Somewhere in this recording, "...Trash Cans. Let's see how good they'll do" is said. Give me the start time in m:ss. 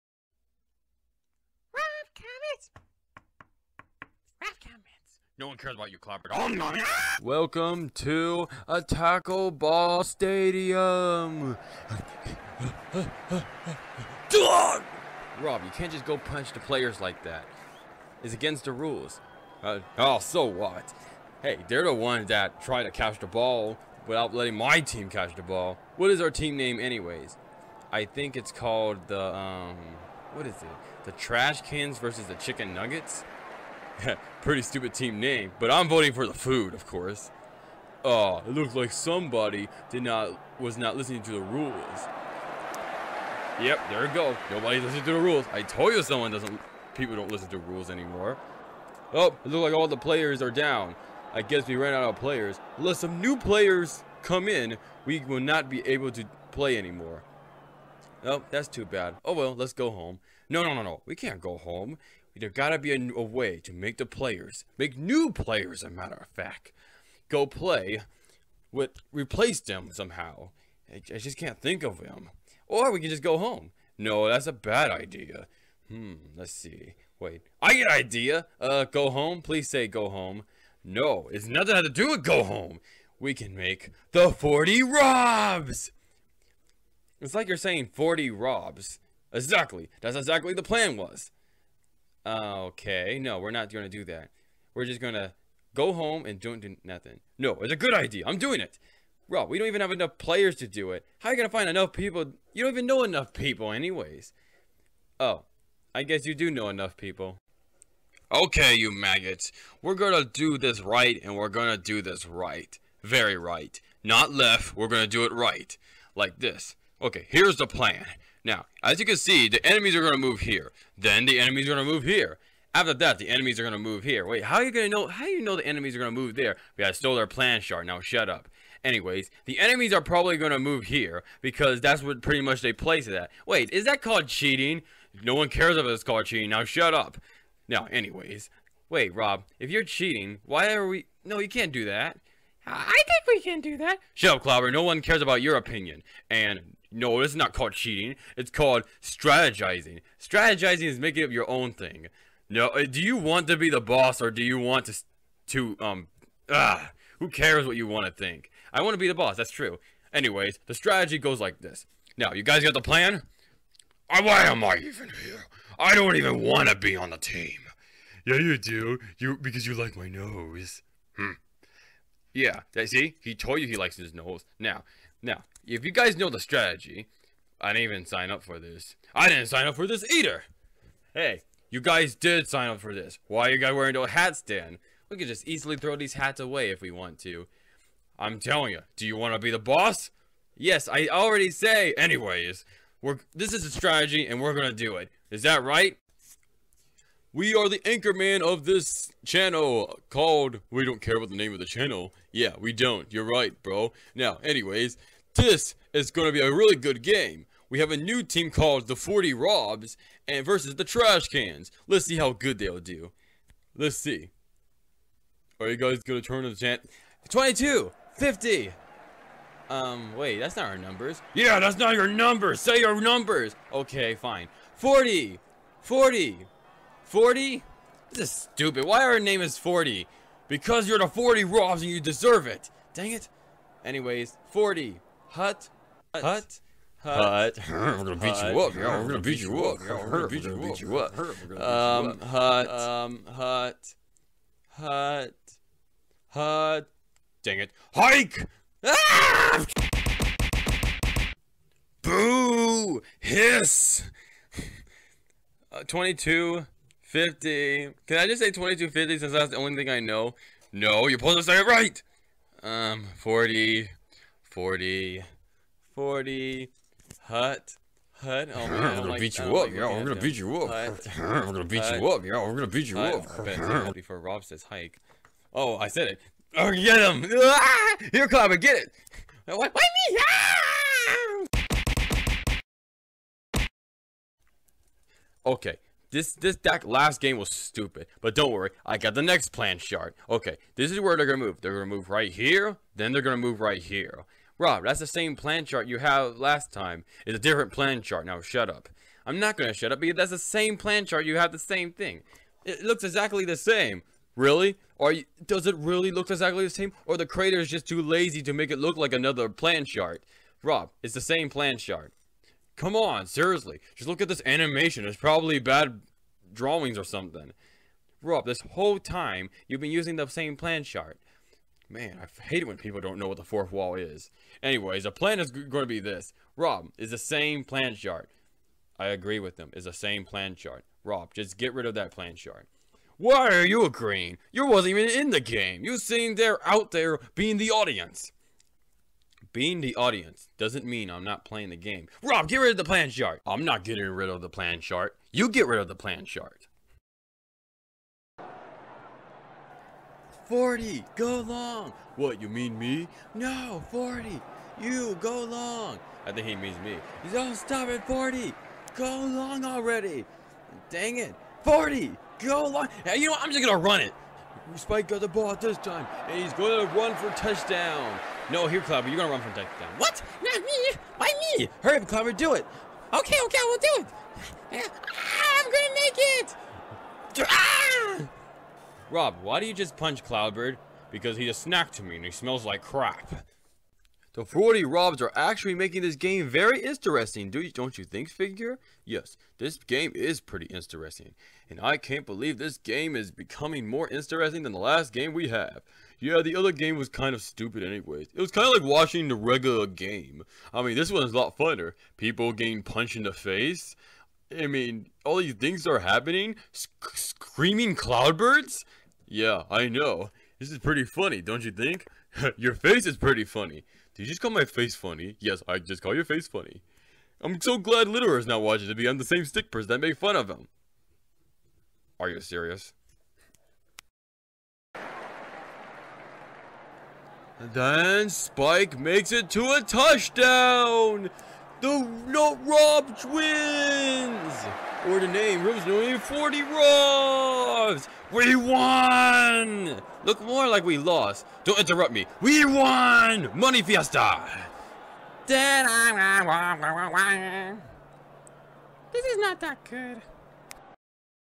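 3:30.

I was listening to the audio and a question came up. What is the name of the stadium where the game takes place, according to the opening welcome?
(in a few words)
Taco Ball Stadium.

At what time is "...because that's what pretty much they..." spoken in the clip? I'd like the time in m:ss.
2:11.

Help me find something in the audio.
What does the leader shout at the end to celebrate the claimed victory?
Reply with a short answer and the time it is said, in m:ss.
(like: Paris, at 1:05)
Money Fiesta, at 7:23.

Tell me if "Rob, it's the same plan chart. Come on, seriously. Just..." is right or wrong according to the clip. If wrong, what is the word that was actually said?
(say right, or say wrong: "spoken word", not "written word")
right.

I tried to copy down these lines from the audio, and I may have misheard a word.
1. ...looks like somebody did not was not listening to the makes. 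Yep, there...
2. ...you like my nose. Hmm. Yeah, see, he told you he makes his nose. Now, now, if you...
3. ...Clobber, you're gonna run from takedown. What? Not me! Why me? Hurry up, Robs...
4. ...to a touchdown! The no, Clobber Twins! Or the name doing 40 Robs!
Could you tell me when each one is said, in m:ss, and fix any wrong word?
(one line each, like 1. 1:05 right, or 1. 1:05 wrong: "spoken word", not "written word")
1. 0:38 wrong: "rules", not "makes"
2. 2:49 wrong: "likes", not "makes"
3. 6:08 wrong: "Clobber", not "Robs"
4. 7:09 wrong: "Rob", not "Clobber".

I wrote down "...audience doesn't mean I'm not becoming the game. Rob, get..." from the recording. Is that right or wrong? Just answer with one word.
wrong.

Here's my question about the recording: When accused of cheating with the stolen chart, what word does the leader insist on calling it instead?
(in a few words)
Strategizing.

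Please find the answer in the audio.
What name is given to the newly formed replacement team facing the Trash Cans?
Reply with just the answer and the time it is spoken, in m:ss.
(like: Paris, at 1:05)
40 Robs, at 3:27.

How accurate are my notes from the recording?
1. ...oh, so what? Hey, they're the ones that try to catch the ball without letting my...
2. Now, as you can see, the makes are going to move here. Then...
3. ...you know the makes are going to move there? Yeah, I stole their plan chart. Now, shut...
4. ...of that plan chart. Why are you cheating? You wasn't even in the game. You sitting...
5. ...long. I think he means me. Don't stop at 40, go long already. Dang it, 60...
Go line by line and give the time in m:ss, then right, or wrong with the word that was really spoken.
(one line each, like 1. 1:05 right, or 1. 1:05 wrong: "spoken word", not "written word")
1. 0:19 right
2. 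1:58 wrong: "enemies", not "makes"
3. 2:05 wrong: "enemies", not "makes"
4. 5:31 wrong: "agreeing", not "cheating"
5. 5:55 wrong: "40", not "60".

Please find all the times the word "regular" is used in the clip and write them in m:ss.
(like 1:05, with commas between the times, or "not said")
6:39.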